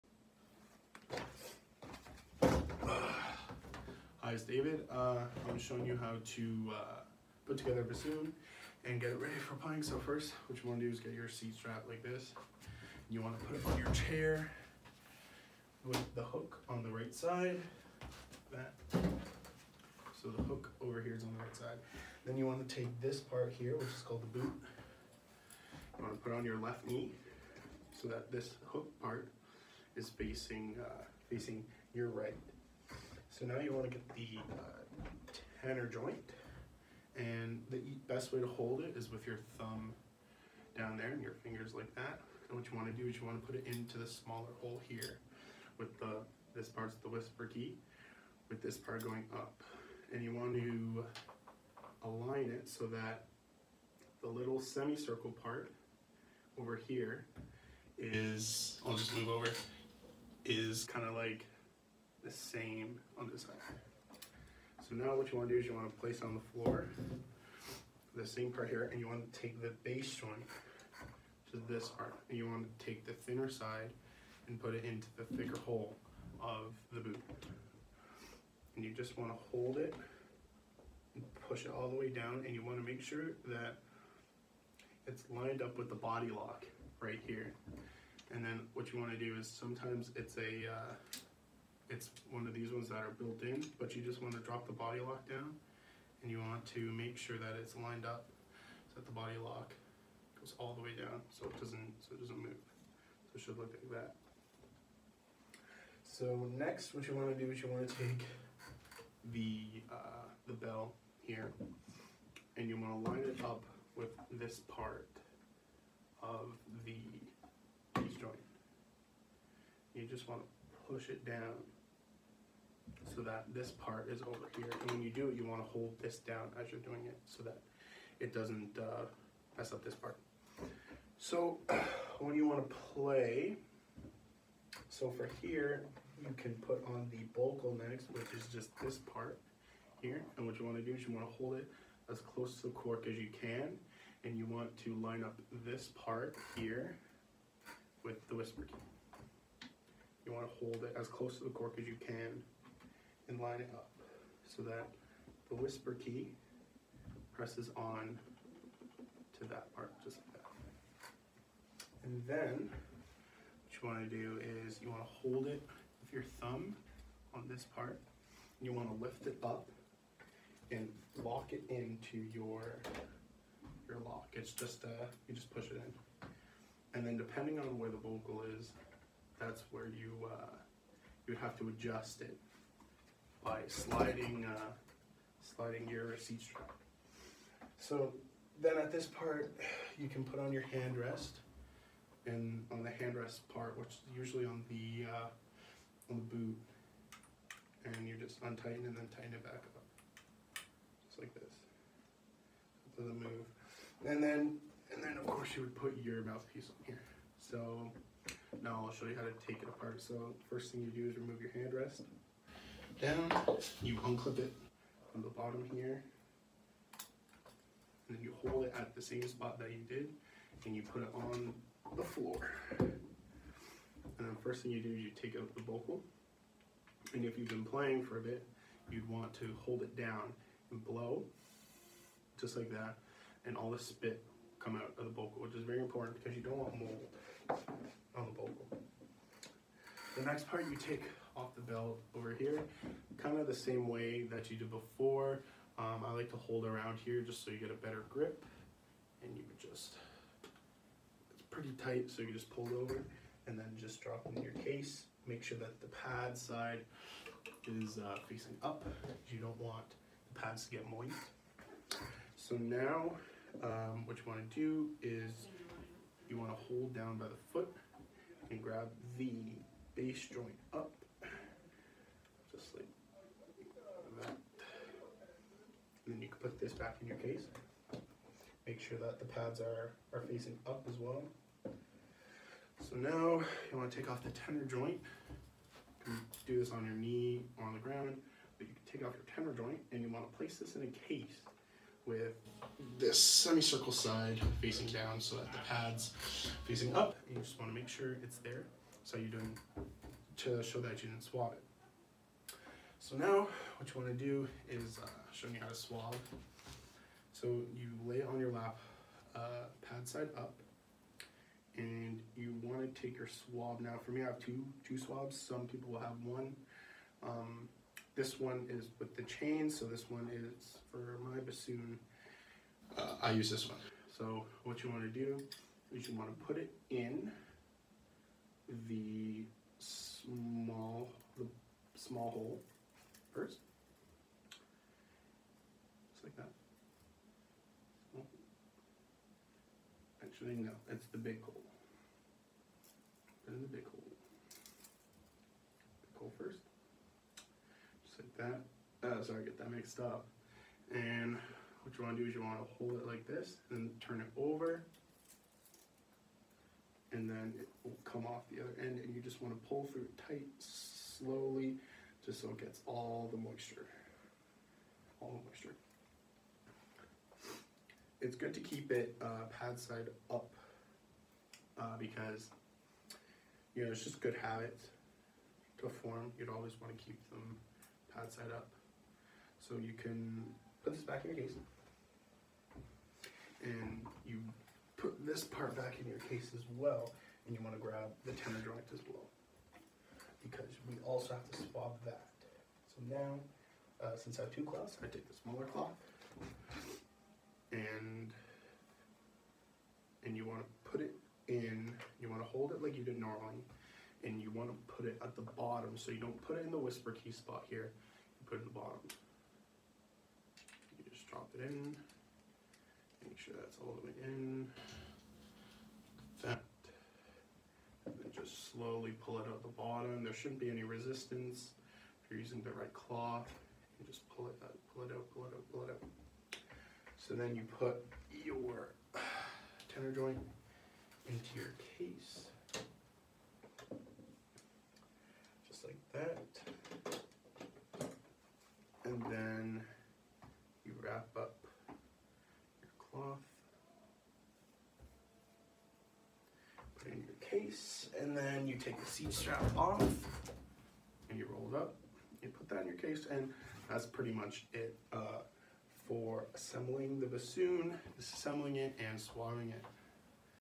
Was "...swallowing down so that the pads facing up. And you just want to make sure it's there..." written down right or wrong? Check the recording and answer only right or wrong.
wrong.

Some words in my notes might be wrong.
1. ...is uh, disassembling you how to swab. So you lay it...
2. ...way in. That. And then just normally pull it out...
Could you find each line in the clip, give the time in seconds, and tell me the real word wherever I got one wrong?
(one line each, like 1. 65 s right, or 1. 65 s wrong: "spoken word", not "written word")
1. 304 s wrong: "showing", not "disassembling"
2. 414 s wrong: "slowly", not "normally".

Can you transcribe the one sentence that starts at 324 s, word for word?
So what you want to do is you want to put it in the small the small hole first.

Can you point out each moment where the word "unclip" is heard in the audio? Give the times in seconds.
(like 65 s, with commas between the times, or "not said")
214 s.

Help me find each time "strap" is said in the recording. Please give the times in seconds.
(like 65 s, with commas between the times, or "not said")
11 s, 186 s, 449 s.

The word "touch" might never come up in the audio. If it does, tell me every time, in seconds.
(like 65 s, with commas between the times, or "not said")
not said.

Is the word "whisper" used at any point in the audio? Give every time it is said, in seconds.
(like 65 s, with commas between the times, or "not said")
47 s, 148 s, 155 s, 406 s.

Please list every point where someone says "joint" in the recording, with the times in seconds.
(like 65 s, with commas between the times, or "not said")
35 s, 70 s, 117 s, 270 s, 284 s, 289 s, 388 s, 430 s.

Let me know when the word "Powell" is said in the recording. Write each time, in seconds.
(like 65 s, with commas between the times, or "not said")
not said.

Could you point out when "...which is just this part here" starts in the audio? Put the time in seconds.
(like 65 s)
138 s.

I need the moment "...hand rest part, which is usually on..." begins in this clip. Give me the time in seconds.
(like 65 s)
192 s.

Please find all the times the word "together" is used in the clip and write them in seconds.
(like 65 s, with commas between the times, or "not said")
7 s.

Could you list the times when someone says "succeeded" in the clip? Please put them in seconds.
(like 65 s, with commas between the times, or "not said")
not said.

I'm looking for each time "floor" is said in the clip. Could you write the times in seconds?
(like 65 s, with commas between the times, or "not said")
66 s, 222 s.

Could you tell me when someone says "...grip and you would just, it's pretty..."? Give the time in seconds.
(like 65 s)
248 s.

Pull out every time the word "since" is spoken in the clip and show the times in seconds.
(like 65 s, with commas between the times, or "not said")
394 s.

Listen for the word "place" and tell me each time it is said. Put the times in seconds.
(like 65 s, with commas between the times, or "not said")
65 s, 290 s.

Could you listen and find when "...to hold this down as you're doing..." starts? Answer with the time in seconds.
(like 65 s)
125 s.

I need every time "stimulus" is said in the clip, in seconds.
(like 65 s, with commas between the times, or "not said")
not said.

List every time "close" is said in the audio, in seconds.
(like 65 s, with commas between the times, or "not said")
142 s, 151 s.